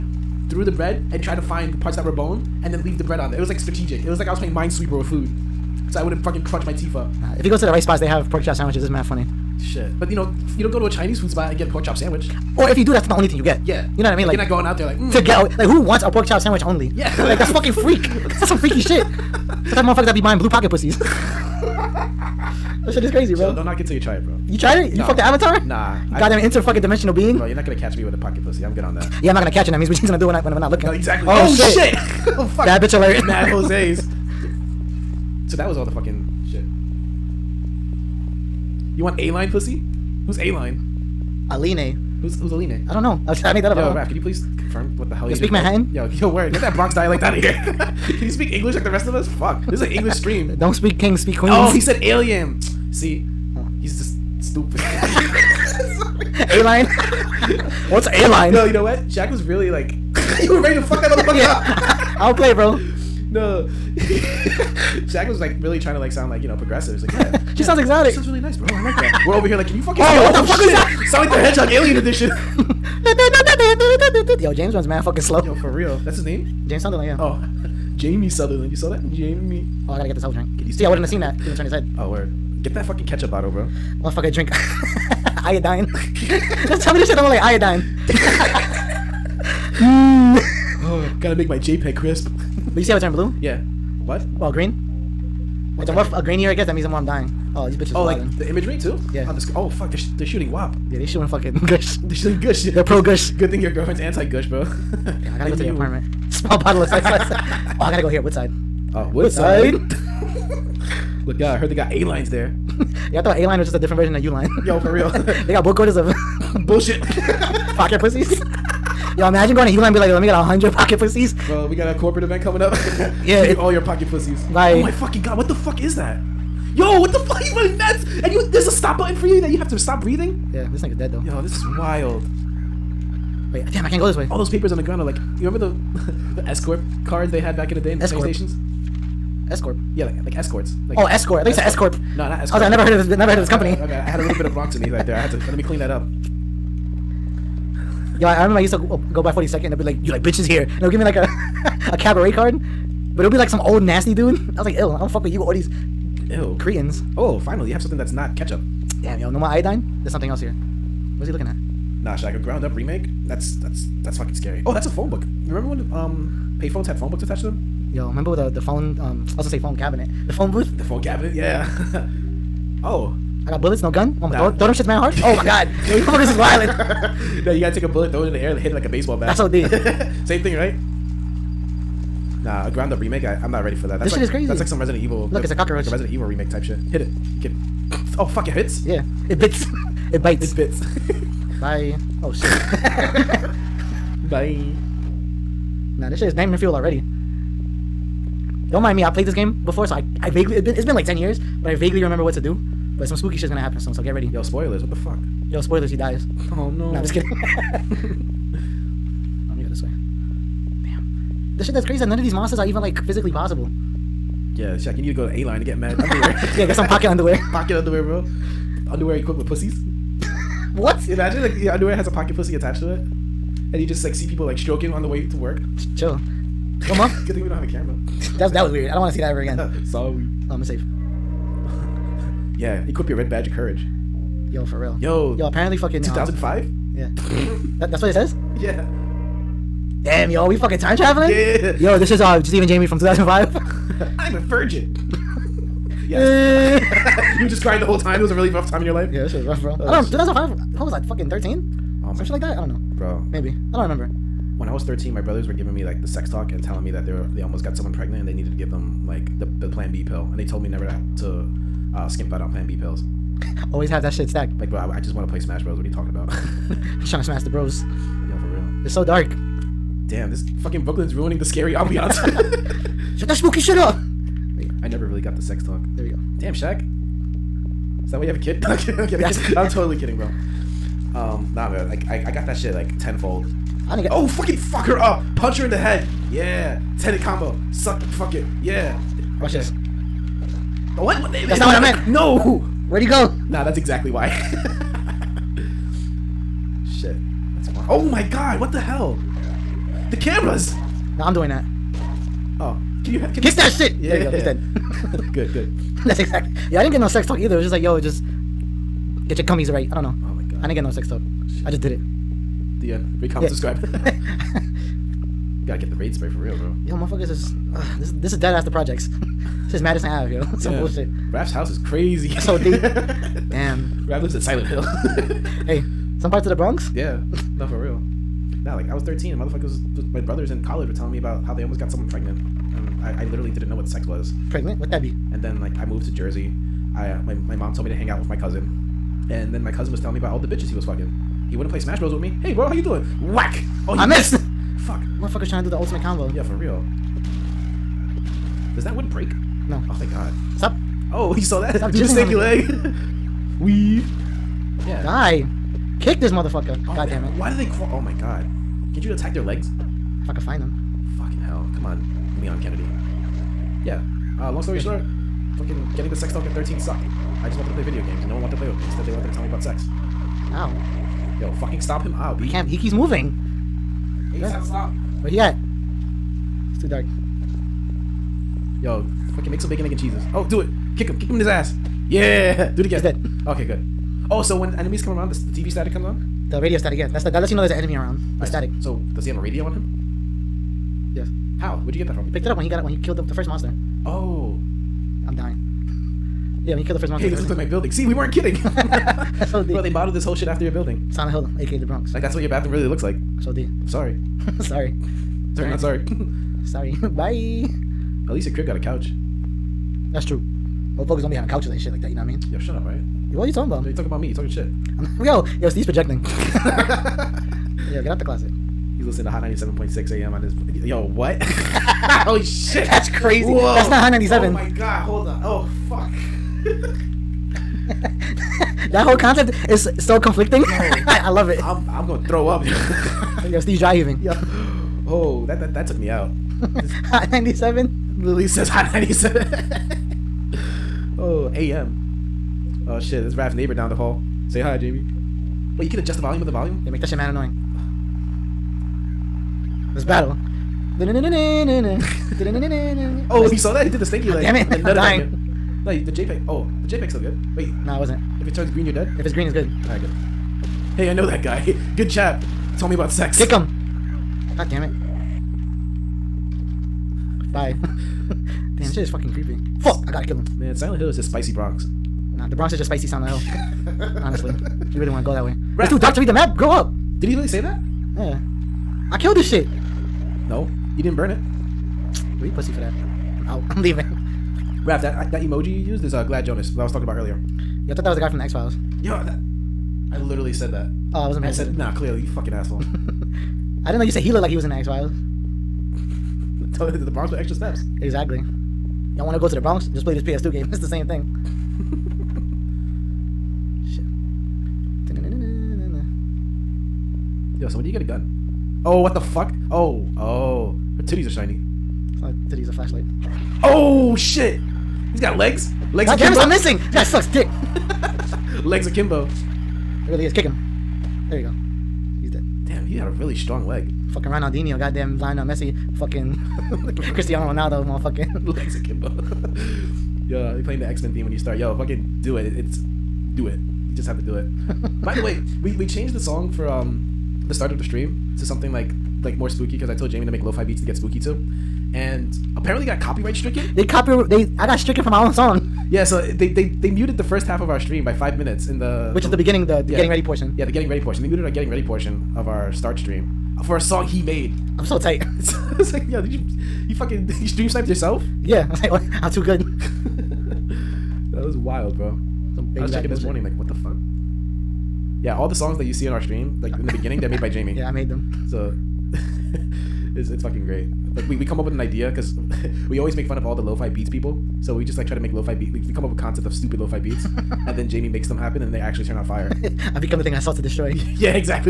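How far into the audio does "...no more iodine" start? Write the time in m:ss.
2:39.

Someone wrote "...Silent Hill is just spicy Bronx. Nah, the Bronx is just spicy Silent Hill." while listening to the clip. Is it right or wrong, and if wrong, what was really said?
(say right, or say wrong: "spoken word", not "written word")
right.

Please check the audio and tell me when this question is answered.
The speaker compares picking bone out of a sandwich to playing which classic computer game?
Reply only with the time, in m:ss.
0:04.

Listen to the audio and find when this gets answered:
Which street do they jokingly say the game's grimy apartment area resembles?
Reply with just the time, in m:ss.
5:19.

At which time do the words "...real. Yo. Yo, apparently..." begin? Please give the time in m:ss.
3:54.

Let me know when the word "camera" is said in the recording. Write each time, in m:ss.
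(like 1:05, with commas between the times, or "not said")
3:47, 5:00.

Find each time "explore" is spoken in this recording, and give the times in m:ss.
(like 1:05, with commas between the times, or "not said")
not said.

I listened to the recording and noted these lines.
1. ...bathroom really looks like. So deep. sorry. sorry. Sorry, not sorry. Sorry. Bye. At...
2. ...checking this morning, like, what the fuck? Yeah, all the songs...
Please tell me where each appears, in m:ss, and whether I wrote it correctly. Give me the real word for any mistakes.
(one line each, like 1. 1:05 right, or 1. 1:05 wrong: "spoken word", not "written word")
1. 6:42 right
2. 9:22 right.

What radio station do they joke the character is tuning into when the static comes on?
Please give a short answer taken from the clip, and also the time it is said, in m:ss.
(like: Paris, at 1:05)
Hot 97, at 6:59.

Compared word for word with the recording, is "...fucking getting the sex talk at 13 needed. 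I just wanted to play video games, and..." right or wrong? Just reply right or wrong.
wrong.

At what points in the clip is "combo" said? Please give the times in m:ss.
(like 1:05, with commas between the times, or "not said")
4:47, 5:46.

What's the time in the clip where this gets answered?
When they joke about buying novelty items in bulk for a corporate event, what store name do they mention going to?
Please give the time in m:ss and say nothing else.
1:59.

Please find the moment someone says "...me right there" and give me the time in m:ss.
2:24.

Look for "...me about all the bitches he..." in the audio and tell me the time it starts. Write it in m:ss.
5:40.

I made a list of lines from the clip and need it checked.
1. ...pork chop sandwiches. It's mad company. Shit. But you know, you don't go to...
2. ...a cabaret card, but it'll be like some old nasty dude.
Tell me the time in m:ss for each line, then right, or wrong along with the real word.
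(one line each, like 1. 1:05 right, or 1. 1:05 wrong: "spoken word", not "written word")
1. 0:08 wrong: "funny", not "company"
2. 2:31 right.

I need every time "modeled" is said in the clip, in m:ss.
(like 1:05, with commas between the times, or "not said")
6:39.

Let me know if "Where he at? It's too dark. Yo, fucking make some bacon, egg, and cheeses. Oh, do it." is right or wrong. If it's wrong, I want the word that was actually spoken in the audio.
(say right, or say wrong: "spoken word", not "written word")
right.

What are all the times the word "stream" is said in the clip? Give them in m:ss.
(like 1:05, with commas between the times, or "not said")
0:50, 8:57, 9:07, 9:12, 9:17, 9:26.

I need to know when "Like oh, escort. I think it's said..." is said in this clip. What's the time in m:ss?
2:20.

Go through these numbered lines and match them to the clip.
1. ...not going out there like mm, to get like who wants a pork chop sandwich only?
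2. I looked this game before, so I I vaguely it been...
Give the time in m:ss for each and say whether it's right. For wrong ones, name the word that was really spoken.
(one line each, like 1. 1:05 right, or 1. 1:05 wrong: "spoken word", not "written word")
1. 0:14 right
2. 3:19 wrong: "played", not "looked".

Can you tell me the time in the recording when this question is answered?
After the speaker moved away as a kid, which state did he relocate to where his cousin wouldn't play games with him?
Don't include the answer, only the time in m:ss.
5:36.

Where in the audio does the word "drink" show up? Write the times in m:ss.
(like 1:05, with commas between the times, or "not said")
1:20, 1:24.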